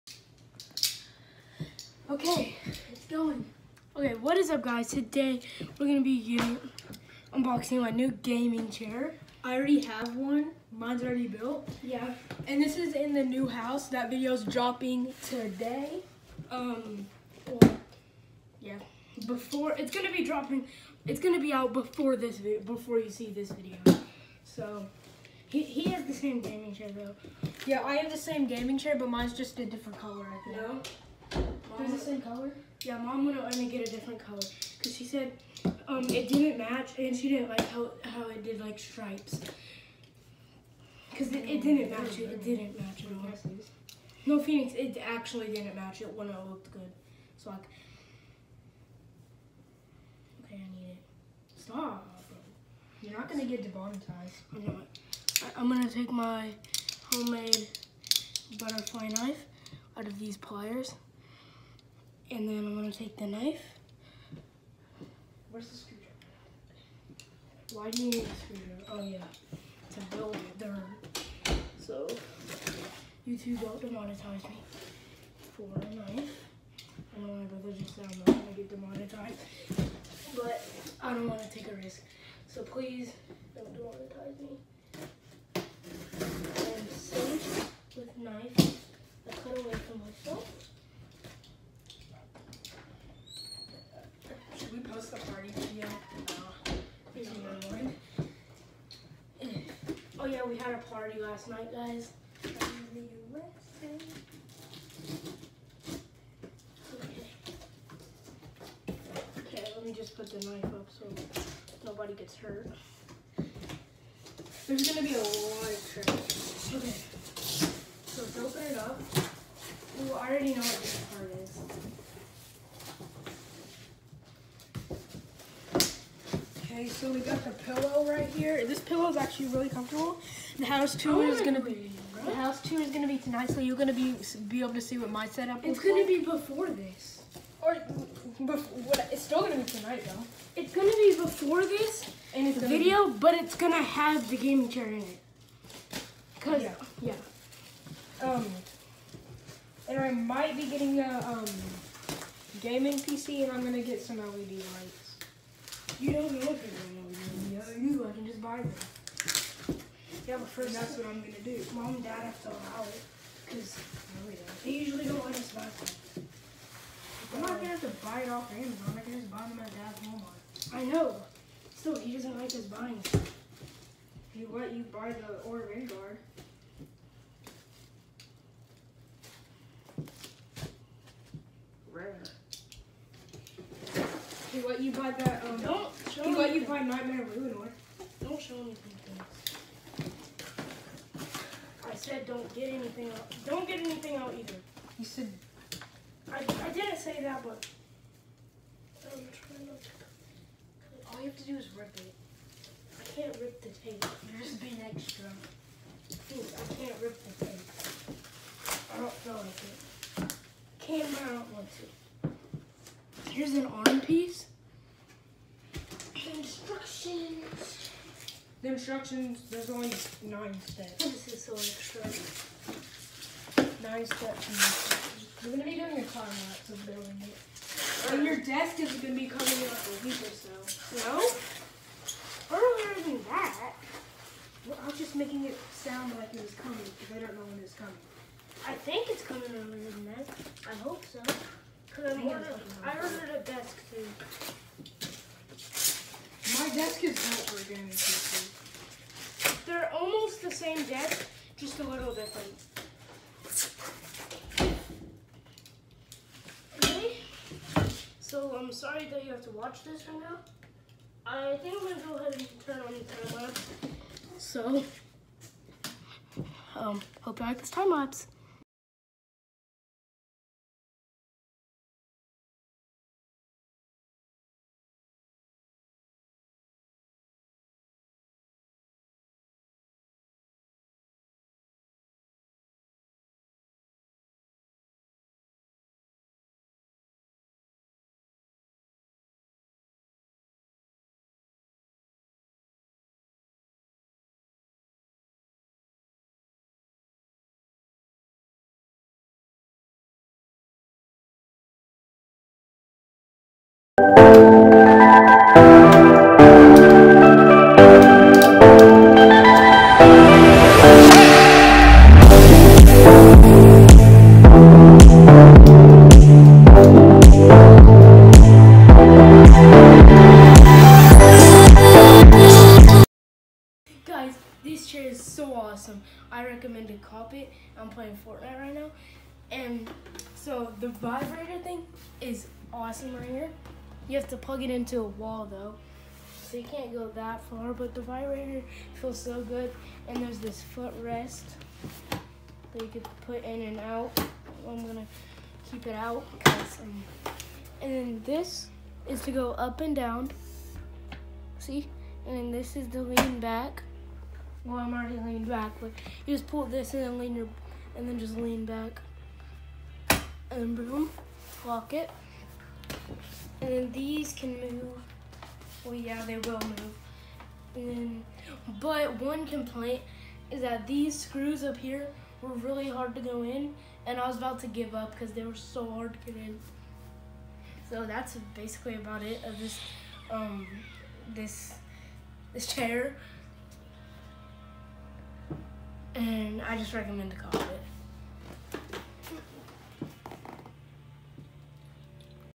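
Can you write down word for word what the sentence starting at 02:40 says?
Yeah, but first that's what I'm gonna do.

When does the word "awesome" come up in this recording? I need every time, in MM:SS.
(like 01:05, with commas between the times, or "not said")
05:25, 05:32.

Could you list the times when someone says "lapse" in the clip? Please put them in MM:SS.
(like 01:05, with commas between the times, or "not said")
04:23, 04:27.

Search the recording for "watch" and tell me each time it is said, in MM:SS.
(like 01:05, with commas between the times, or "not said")
04:19.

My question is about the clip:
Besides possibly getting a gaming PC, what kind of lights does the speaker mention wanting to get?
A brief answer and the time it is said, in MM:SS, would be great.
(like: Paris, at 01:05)
LED lights, at 02:34.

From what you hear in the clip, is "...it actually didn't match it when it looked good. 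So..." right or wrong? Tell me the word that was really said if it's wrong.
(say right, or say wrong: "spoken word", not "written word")
right.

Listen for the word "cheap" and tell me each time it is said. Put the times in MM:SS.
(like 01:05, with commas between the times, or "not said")
not said.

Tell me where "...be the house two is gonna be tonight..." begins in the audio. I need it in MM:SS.
02:11.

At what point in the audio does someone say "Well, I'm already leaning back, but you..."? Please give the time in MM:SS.
05:54.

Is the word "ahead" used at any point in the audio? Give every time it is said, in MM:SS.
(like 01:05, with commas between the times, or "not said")
04:22.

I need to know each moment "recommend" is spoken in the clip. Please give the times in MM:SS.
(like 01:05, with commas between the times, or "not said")
05:26, 06:26.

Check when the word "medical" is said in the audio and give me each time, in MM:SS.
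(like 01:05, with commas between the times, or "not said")
not said.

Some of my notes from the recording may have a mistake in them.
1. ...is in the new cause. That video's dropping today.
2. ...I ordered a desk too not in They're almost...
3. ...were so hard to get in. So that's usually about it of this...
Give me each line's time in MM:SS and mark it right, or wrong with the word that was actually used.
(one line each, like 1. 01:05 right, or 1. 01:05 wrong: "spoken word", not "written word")
1. 00:12 wrong: "house", not "cause"
2. 04:02 right
3. 06:15 wrong: "basically", not "usually".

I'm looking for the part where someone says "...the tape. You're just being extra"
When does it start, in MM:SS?
03:23.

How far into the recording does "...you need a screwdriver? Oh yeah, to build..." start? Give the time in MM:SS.
01:08.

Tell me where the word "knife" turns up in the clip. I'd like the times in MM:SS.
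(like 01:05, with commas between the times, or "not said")
00:59, 01:03, 01:15, 01:50.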